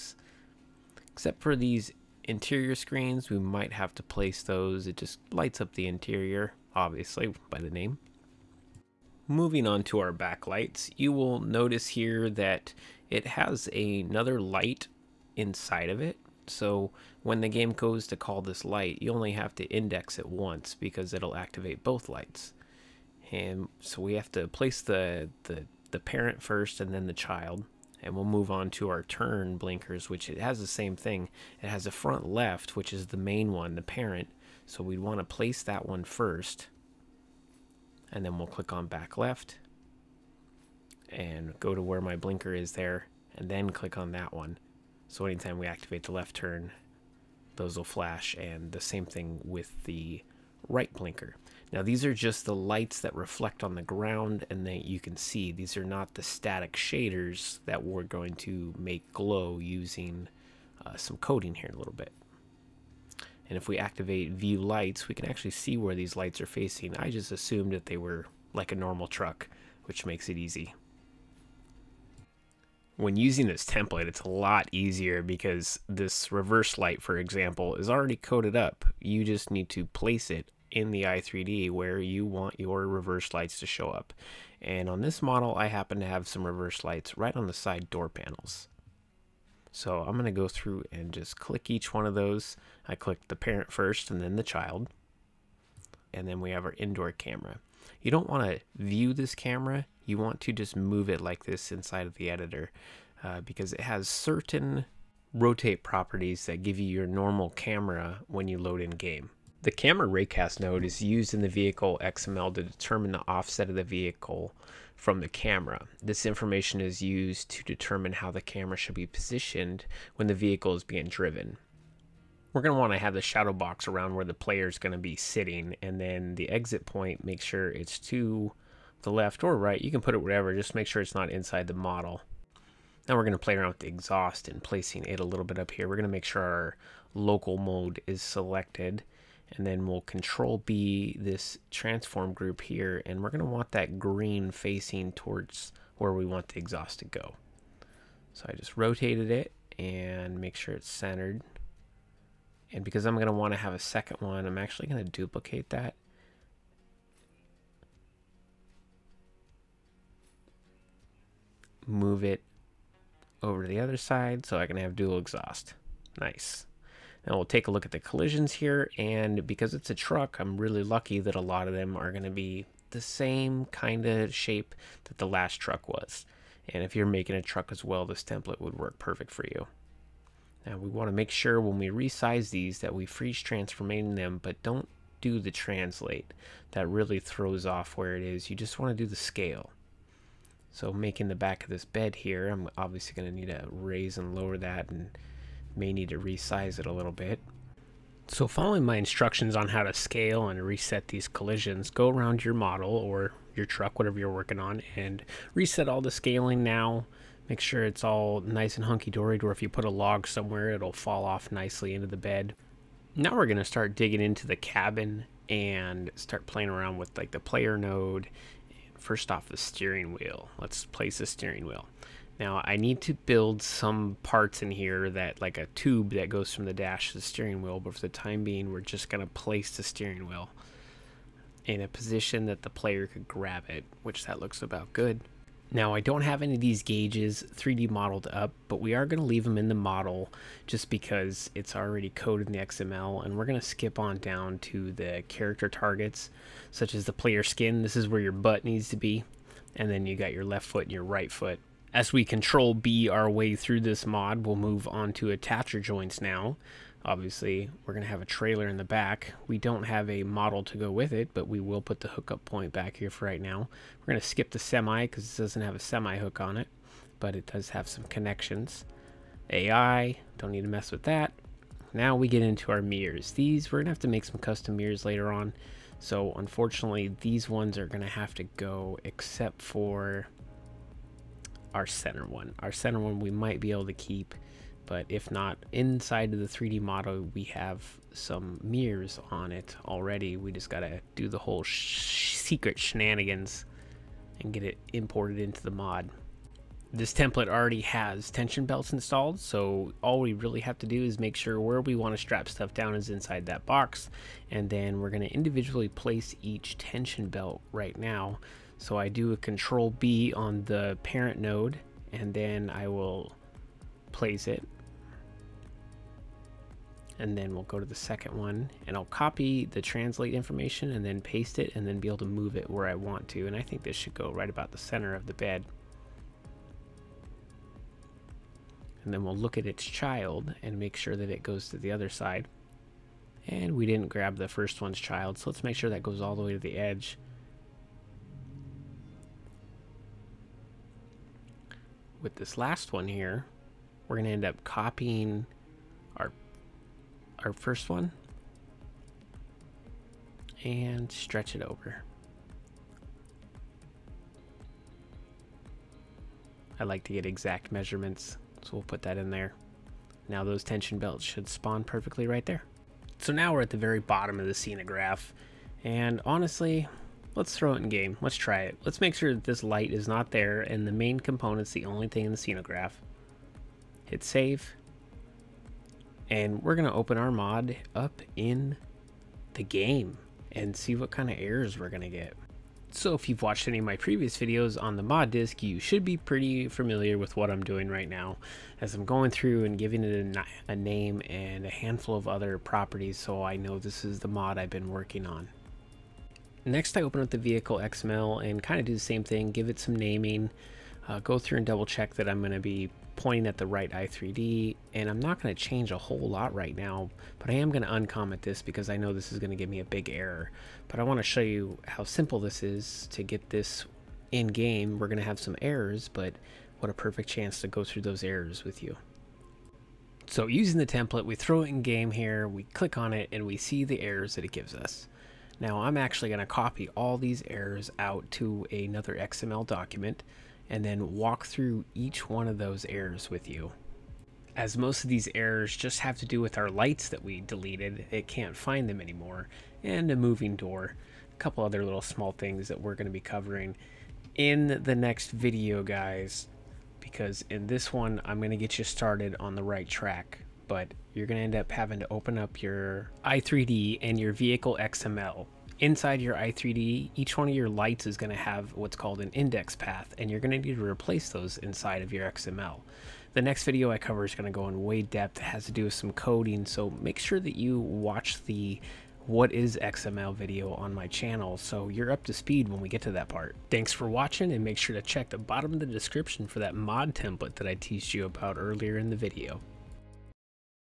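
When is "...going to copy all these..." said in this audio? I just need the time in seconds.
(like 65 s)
426 s.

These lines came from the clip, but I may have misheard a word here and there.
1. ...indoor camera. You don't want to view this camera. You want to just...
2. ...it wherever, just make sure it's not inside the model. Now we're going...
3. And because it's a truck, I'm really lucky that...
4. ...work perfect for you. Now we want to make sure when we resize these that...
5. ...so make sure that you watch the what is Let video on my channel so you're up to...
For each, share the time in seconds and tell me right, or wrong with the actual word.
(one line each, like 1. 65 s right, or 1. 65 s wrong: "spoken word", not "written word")
1. 96 s right
2. 130 s right
3. 168 s right
4. 178 s right
5. 466 s wrong: "XML", not "Let".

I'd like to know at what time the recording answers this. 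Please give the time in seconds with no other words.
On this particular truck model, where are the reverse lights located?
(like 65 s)
87 s.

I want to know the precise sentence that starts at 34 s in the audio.
So we'd want to place that one first.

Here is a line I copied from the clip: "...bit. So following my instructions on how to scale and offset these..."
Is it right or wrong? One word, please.
wrong.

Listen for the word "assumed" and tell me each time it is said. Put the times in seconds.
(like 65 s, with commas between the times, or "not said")
67 s.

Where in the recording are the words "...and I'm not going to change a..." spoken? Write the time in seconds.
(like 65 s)
404 s.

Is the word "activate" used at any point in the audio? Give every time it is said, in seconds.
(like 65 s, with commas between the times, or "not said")
21 s, 45 s, 63 s.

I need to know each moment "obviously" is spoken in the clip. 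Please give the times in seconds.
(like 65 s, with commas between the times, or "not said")
6 s, 192 s, 257 s.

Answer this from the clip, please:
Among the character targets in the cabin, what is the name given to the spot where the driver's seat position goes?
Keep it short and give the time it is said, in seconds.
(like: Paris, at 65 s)
Player skin, at 247 s.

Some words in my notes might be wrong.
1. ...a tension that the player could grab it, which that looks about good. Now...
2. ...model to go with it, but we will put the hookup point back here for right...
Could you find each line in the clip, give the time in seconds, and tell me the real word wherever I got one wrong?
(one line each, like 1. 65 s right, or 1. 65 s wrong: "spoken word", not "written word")
1. 231 s wrong: "position", not "tension"
2. 260 s right.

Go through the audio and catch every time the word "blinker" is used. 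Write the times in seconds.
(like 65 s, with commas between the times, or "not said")
29 s, 42 s, 50 s.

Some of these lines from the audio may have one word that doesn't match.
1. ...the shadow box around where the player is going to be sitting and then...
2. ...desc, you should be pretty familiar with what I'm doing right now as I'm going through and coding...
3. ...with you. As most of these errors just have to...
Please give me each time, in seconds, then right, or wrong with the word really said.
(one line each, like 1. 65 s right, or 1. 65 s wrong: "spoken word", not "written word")
1. 123 s right
2. 385 s wrong: "giving", not "coding"
3. 433 s right.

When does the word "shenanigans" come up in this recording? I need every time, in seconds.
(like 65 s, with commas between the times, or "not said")
292 s.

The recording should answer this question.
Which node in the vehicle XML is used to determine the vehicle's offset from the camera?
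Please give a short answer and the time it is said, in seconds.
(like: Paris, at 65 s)
Camera raycast node, at 109 s.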